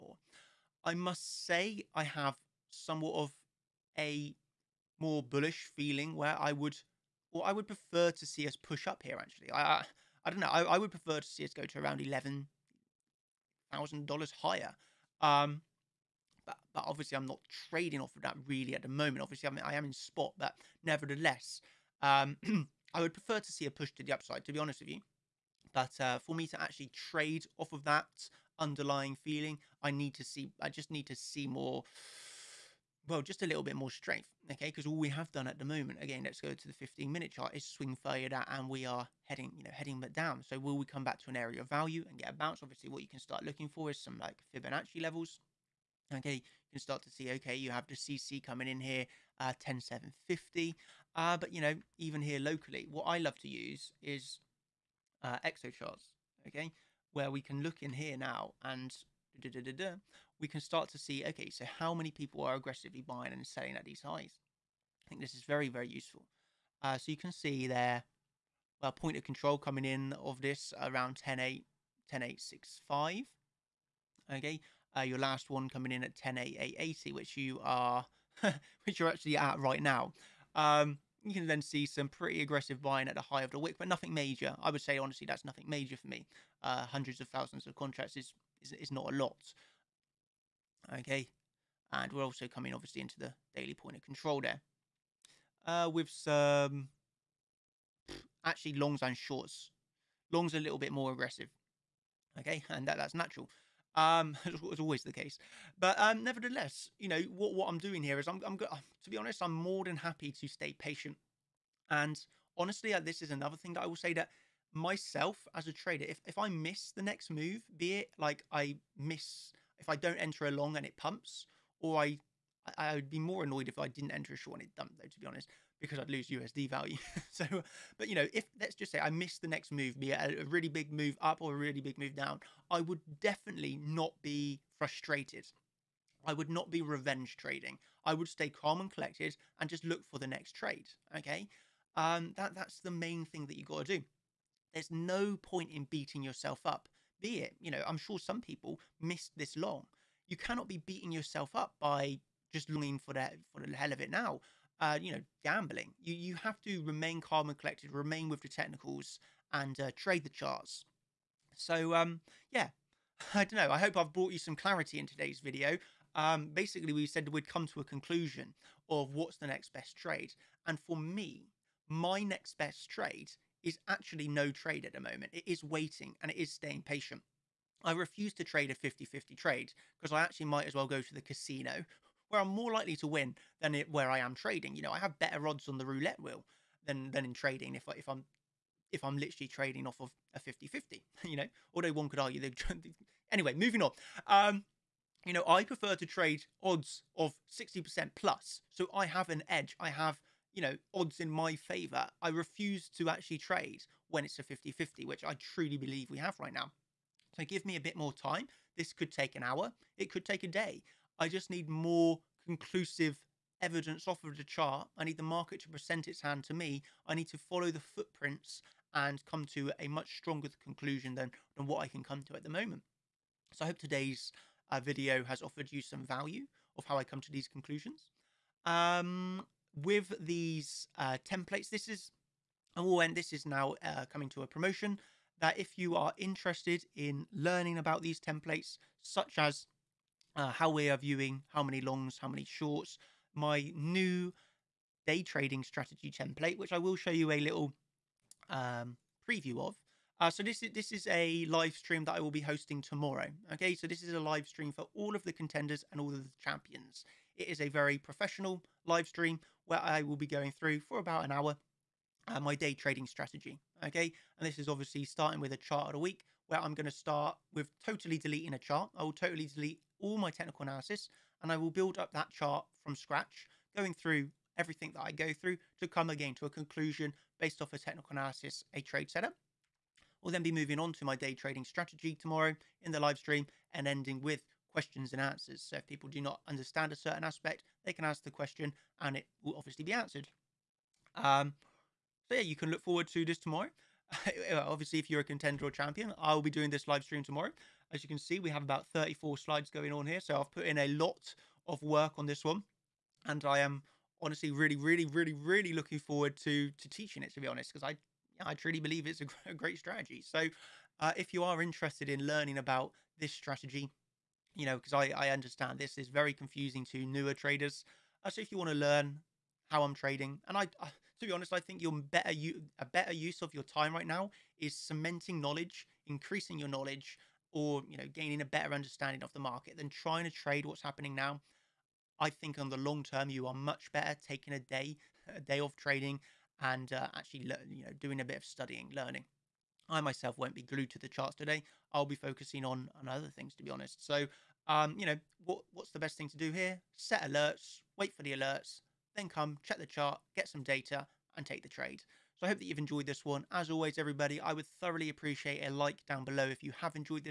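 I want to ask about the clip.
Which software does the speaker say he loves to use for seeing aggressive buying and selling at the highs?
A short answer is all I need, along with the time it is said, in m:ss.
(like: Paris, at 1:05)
Exocharts, at 0:55.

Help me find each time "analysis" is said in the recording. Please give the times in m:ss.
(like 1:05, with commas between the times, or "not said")
4:30, 4:38.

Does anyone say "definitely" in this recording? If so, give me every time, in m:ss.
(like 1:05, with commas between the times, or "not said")
2:13.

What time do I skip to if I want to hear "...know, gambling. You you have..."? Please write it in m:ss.
2:35.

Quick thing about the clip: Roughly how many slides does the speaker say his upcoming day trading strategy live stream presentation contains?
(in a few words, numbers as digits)
34.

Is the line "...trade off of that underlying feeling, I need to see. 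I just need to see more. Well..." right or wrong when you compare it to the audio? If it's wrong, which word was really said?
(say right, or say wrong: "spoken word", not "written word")
right.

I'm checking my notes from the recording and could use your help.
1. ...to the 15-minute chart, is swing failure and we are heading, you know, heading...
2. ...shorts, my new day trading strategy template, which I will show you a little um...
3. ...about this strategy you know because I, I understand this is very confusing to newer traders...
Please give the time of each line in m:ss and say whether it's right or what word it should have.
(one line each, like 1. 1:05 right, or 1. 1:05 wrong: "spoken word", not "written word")
1. 0:36 right
2. 4:02 right
3. 5:12 right.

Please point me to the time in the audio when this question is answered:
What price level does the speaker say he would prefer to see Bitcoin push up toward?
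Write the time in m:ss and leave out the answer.
0:11.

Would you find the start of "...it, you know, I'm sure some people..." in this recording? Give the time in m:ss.
2:27.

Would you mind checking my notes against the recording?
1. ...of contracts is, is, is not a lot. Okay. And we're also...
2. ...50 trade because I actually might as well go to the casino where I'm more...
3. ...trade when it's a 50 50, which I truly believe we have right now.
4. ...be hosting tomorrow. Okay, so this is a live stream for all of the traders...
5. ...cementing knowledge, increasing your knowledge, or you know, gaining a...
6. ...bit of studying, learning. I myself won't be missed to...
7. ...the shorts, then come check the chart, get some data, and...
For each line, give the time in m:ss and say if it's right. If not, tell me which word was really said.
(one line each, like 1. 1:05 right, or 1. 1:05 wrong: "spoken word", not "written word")
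1. 1:27 right
2. 2:59 right
3. 3:23 right
4. 4:12 wrong: "contenders", not "traders"
5. 5:24 right
6. 5:38 wrong: "glued", not "missed"
7. 5:48 wrong: "alerts", not "shorts".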